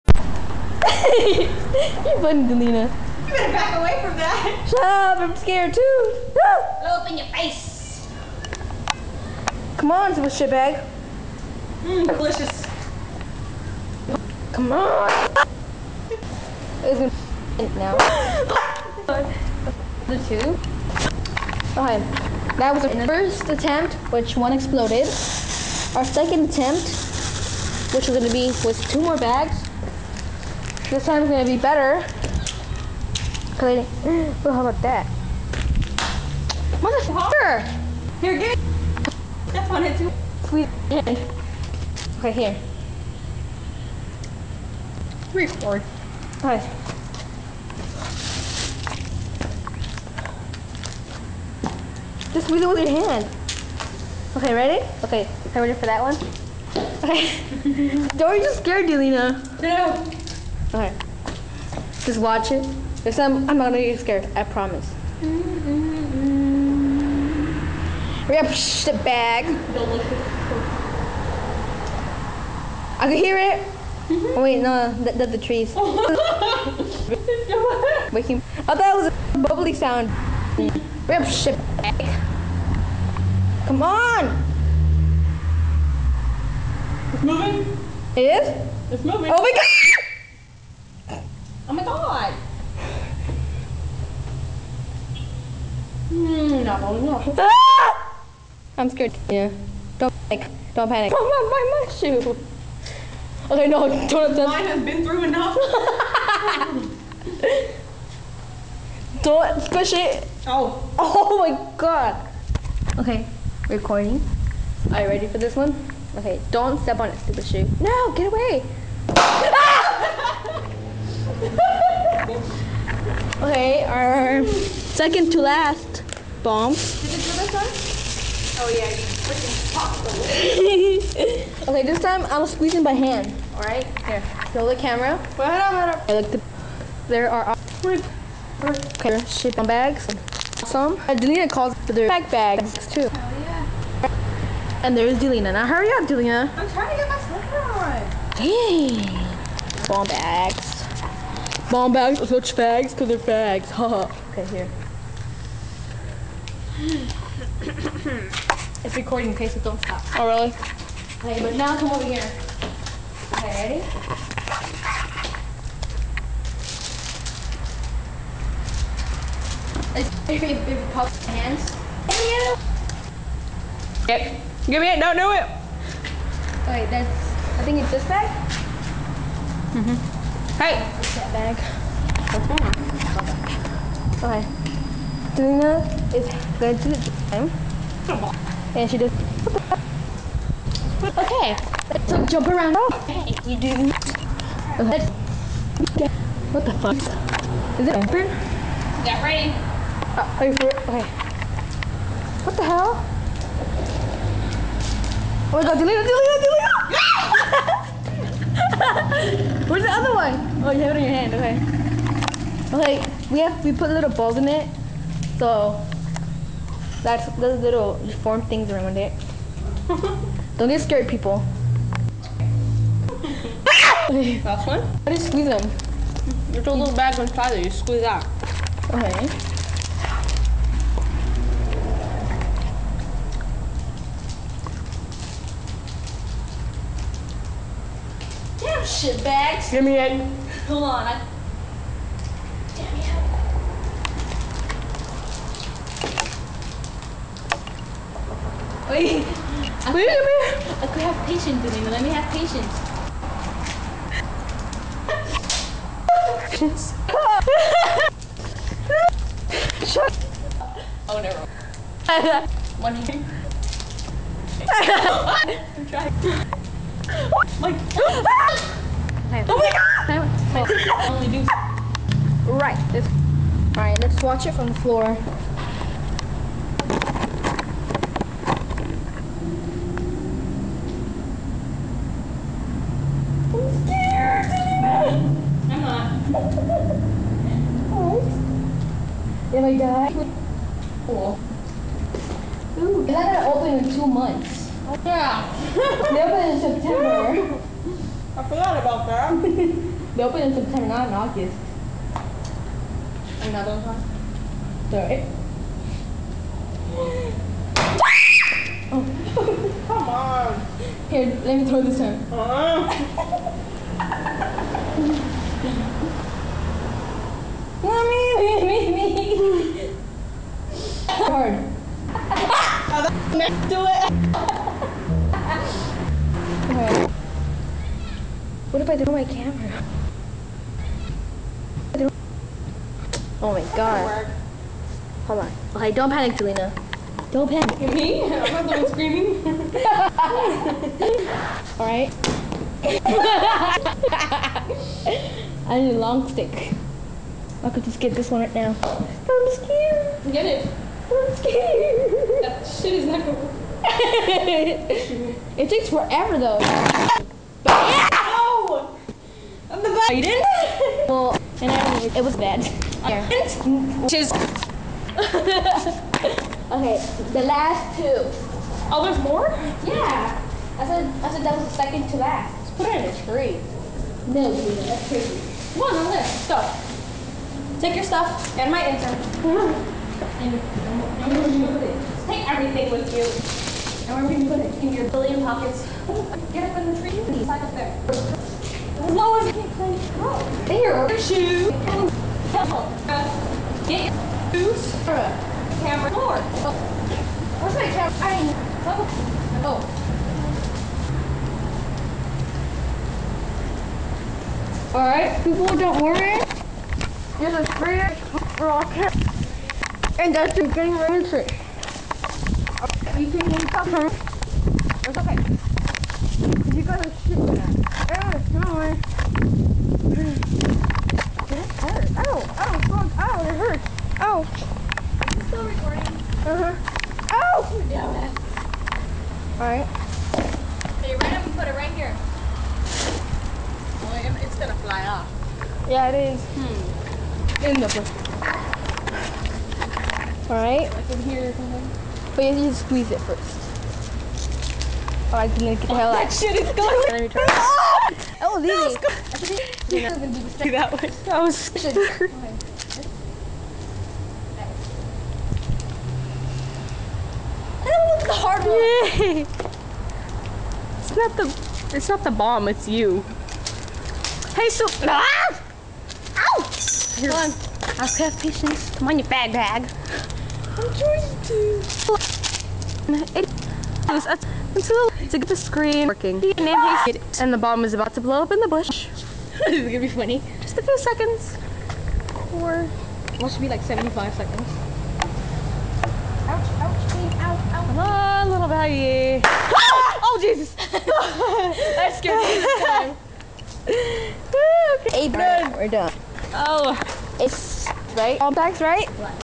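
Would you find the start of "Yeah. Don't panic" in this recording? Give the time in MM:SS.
01:39.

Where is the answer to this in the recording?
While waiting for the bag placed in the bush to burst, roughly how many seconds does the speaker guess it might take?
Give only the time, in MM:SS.
08:03.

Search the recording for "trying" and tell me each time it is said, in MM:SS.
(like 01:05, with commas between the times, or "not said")
02:26, 04:25, 07:50.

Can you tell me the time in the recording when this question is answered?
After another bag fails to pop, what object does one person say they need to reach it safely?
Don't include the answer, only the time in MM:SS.
05:45.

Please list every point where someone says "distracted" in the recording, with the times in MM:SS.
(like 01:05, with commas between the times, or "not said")
07:30.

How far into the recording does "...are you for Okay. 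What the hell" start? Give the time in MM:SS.
03:20.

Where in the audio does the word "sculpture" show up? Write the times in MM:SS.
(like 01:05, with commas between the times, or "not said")
not said.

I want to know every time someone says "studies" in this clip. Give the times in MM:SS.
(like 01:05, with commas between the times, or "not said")
not said.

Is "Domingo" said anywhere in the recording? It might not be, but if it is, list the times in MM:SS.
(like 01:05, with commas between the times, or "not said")
04:11.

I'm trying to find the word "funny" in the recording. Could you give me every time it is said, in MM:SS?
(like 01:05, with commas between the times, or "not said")
00:02, 08:00.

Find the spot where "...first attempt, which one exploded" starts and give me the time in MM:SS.
00:23.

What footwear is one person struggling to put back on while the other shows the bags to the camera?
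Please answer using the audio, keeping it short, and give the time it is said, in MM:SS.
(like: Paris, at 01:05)
Slipper, at 02:28.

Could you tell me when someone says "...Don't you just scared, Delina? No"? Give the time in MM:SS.
00:58.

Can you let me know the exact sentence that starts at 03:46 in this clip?
You put a little bag inside it.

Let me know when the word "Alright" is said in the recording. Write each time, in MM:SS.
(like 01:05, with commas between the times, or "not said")
00:46, 05:41, 06:44, 07:09, 07:20.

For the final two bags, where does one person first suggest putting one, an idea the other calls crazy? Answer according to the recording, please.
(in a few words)
In a tree.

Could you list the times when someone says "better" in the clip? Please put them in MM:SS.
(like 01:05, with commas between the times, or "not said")
00:03, 00:31.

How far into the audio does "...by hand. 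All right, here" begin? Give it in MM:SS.
02:12.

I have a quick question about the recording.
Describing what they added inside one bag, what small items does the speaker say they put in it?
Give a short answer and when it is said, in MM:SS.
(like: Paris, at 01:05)
Little balls, at 03:33.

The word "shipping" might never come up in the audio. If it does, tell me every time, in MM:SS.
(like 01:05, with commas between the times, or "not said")
02:19.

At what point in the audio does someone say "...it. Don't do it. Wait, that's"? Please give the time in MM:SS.
02:54.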